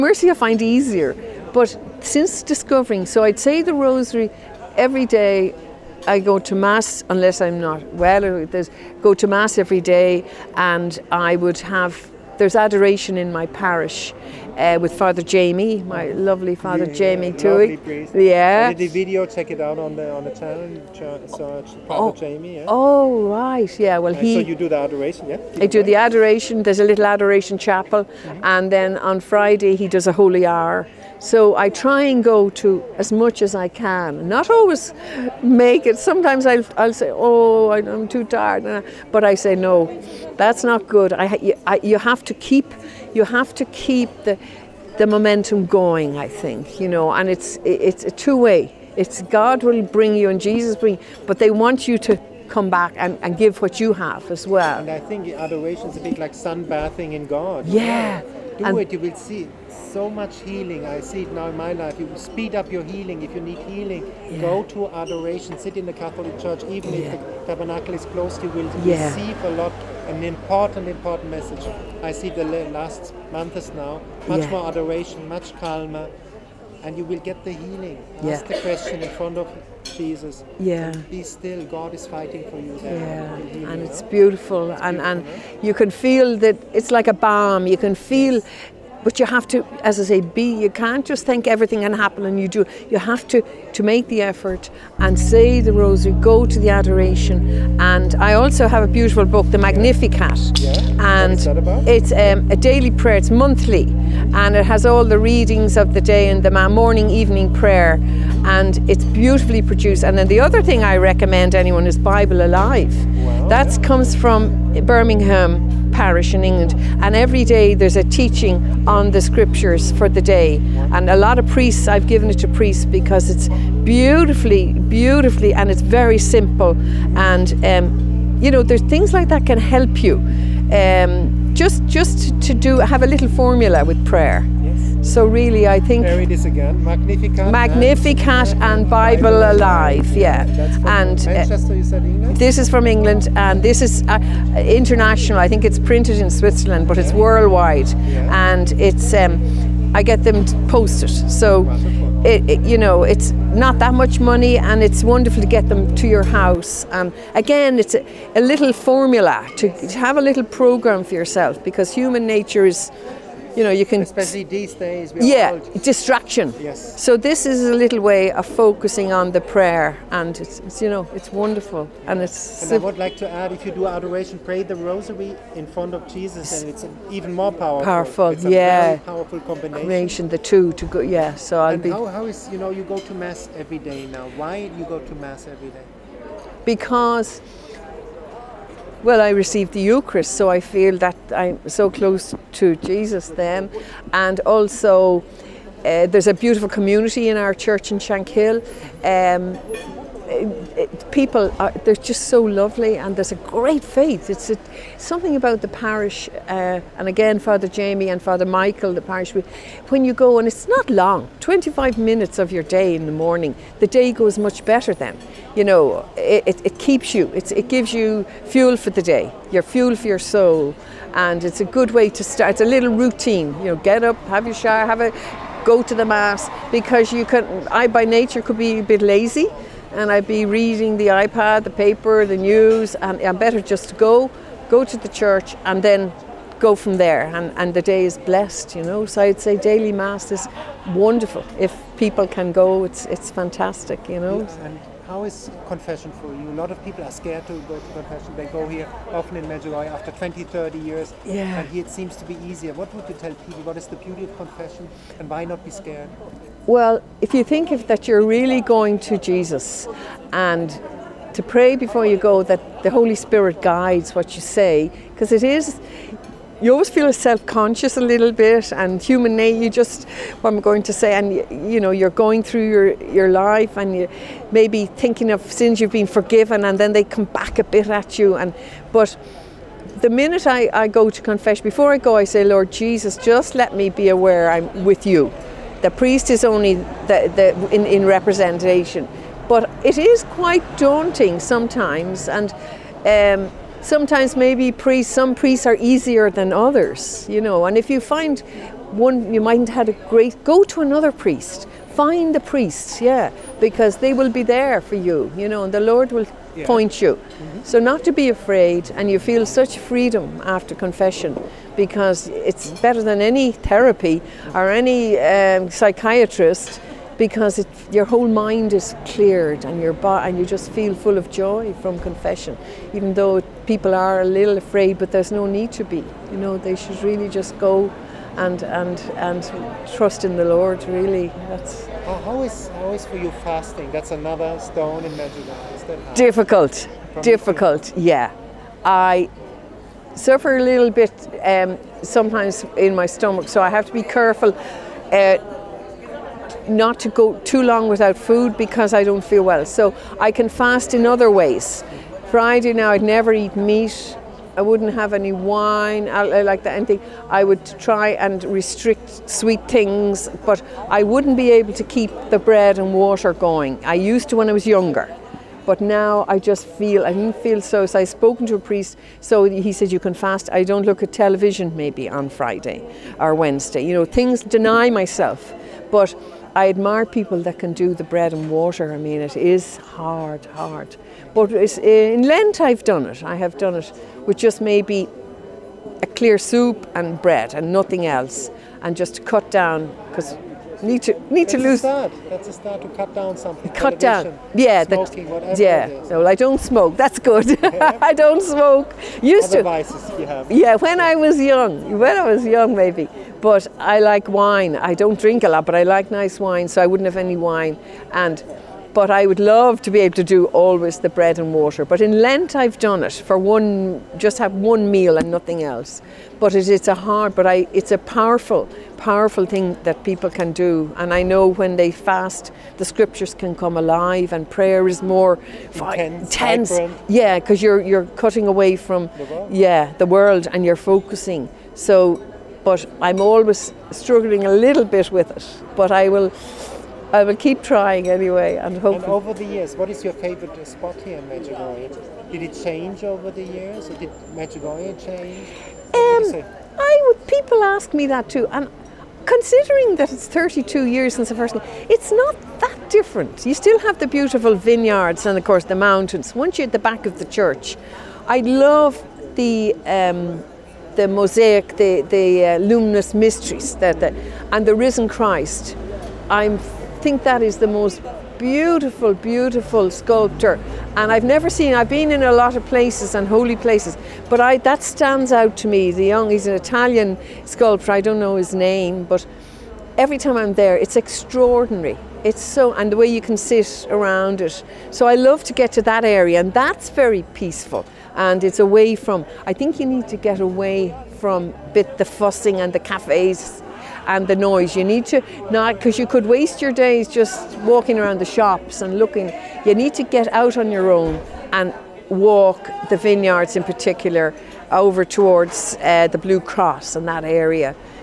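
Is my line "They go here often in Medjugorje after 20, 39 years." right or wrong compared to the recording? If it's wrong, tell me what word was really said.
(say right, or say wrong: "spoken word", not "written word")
wrong: "30", not "39".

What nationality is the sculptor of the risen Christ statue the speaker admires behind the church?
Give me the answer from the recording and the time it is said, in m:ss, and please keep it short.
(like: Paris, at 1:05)
Italian, at 7:56.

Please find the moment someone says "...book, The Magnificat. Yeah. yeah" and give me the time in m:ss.
1:39.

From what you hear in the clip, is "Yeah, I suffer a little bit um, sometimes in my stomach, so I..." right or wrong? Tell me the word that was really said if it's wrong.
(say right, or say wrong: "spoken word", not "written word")
right.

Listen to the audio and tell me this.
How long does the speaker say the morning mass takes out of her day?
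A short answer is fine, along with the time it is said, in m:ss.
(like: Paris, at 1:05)
25 minutes, at 3:31.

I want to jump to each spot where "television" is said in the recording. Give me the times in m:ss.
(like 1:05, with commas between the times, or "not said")
6:11, 6:33.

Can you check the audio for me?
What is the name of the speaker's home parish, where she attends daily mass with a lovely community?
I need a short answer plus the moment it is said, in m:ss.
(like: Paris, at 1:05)
Shankill, at 3:17.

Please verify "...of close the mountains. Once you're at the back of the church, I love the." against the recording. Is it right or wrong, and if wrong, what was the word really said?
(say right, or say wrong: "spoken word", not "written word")
wrong: "course", not "close".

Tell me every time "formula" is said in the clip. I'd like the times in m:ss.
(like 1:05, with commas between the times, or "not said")
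2:13, 2:38.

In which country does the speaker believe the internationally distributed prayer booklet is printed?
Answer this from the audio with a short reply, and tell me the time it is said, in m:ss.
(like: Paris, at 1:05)
Switzerland, at 2:26.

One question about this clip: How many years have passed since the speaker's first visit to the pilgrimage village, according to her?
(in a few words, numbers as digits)
32.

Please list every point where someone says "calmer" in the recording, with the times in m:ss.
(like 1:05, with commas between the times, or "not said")
1:15.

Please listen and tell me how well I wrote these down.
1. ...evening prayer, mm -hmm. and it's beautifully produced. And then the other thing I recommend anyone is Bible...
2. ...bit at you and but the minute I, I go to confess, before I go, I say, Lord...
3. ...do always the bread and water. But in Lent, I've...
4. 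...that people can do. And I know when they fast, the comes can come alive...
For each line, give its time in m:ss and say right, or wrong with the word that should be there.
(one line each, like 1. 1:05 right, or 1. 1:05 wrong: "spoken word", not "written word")
1. 1:47 right
2. 4:37 right
3. 6:50 right
4. 6:59 wrong: "scriptures", not "comes".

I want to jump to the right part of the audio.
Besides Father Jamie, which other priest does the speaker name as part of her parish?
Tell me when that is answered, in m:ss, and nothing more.
3:28.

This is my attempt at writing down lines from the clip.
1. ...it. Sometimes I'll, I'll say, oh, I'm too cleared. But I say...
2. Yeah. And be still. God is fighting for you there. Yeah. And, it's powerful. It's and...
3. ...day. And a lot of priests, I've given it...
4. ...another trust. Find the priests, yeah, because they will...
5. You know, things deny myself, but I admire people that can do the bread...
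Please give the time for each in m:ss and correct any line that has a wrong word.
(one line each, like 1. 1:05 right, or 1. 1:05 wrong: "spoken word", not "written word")
1. 0:35 wrong: "tired", not "cleared"
2. 1:20 wrong: "beautiful", not "powerful"
3. 2:00 right
4. 5:00 wrong: "priest", not "trust"
5. 6:13 right.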